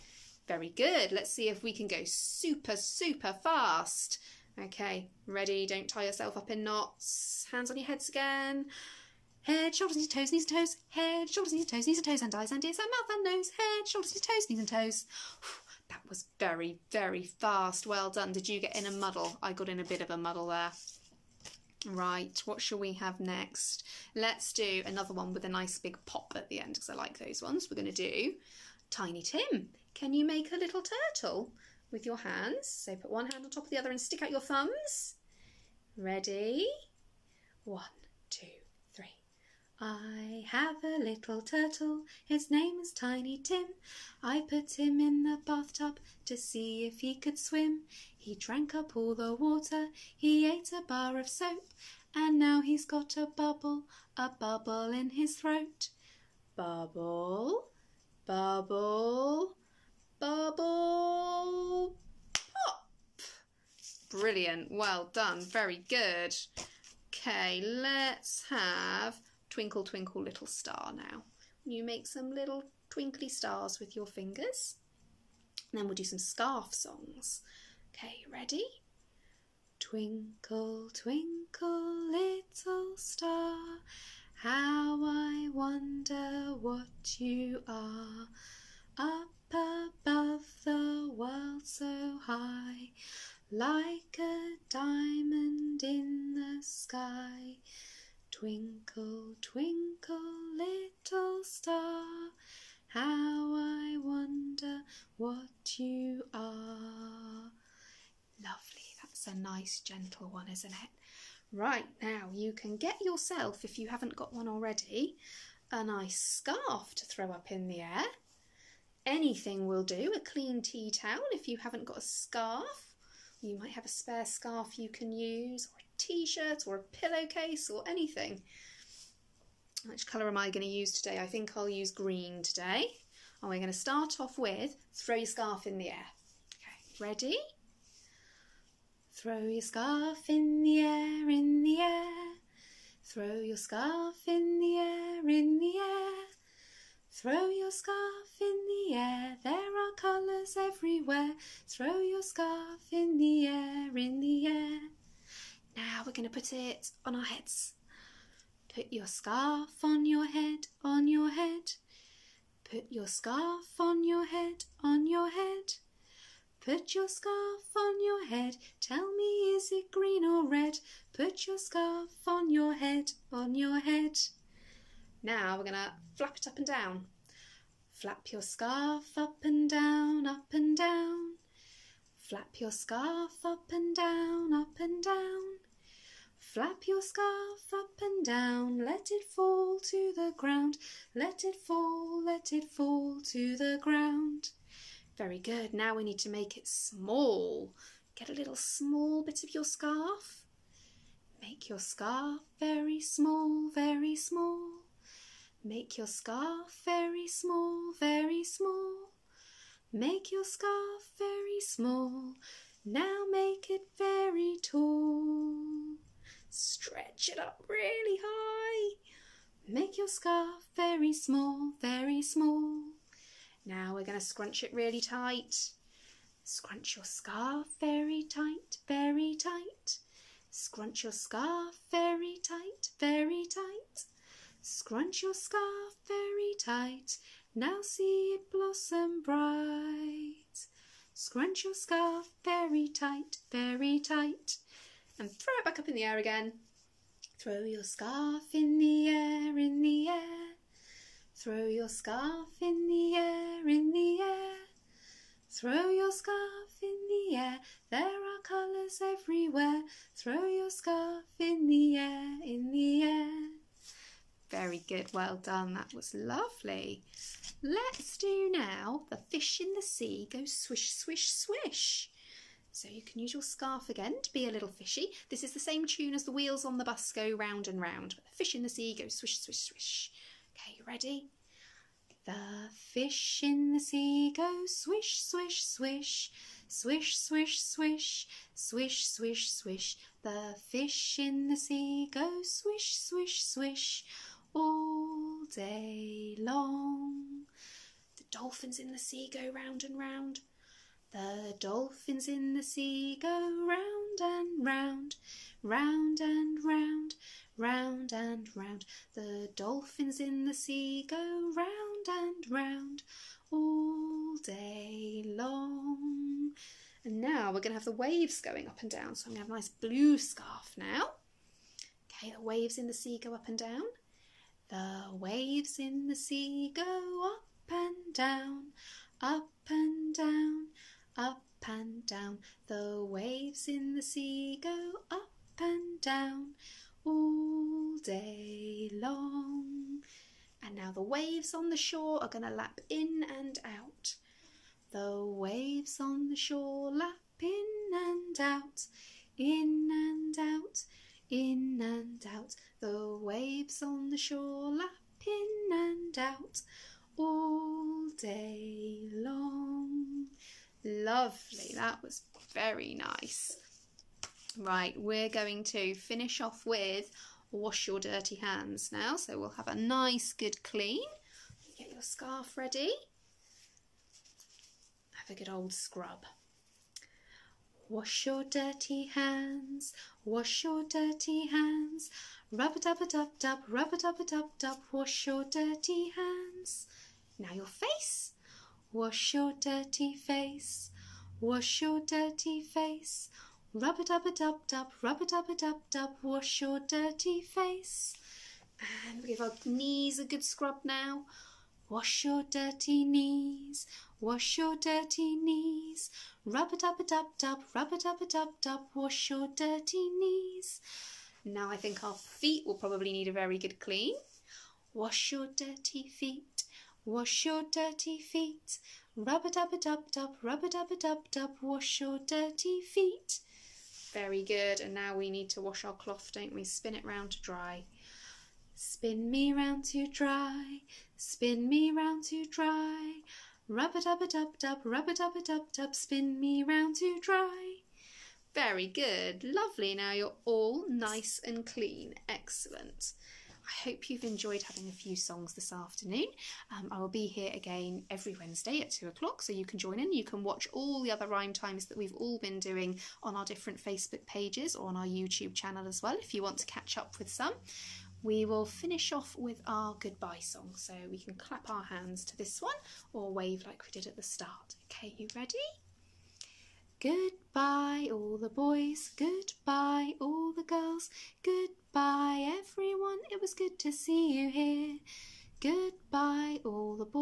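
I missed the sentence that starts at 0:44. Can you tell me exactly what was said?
I put him in the bathtub to see if he could swim.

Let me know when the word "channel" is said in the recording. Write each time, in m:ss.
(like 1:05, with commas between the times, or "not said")
7:35.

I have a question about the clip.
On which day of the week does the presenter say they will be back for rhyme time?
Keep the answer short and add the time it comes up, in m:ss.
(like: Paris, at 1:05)
Wednesday, at 7:28.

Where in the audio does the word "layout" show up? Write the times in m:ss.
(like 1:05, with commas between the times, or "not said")
not said.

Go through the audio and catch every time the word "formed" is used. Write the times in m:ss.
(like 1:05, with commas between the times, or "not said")
not said.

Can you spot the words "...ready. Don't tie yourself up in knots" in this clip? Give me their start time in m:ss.
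0:05.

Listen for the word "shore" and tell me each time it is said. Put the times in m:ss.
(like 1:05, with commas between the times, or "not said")
5:41, 5:46, 5:54.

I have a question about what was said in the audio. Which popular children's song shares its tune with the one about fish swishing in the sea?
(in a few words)
The wheels on the bus.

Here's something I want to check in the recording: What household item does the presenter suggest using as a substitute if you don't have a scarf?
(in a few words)
a clean tea towel.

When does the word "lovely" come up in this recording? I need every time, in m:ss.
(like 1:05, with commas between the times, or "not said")
1:48, 4:26, 6:00, 7:19.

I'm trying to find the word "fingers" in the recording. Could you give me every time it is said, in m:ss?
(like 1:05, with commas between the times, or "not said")
1:14.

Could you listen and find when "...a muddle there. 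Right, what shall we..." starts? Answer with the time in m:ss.
0:20.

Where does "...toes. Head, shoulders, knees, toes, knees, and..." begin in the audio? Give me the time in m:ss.
0:10.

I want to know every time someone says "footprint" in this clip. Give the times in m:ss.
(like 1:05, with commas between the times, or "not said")
not said.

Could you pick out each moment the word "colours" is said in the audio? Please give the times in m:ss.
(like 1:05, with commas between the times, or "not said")
2:10, 2:29, 4:18.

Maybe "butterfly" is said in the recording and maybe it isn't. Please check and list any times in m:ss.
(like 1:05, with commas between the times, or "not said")
not said.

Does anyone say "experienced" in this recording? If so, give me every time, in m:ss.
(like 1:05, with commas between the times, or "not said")
not said.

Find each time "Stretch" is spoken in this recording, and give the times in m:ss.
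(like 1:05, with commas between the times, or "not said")
3:36.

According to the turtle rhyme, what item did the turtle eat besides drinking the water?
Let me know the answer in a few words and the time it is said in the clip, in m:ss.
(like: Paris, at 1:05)
a bar of soap, at 0:50.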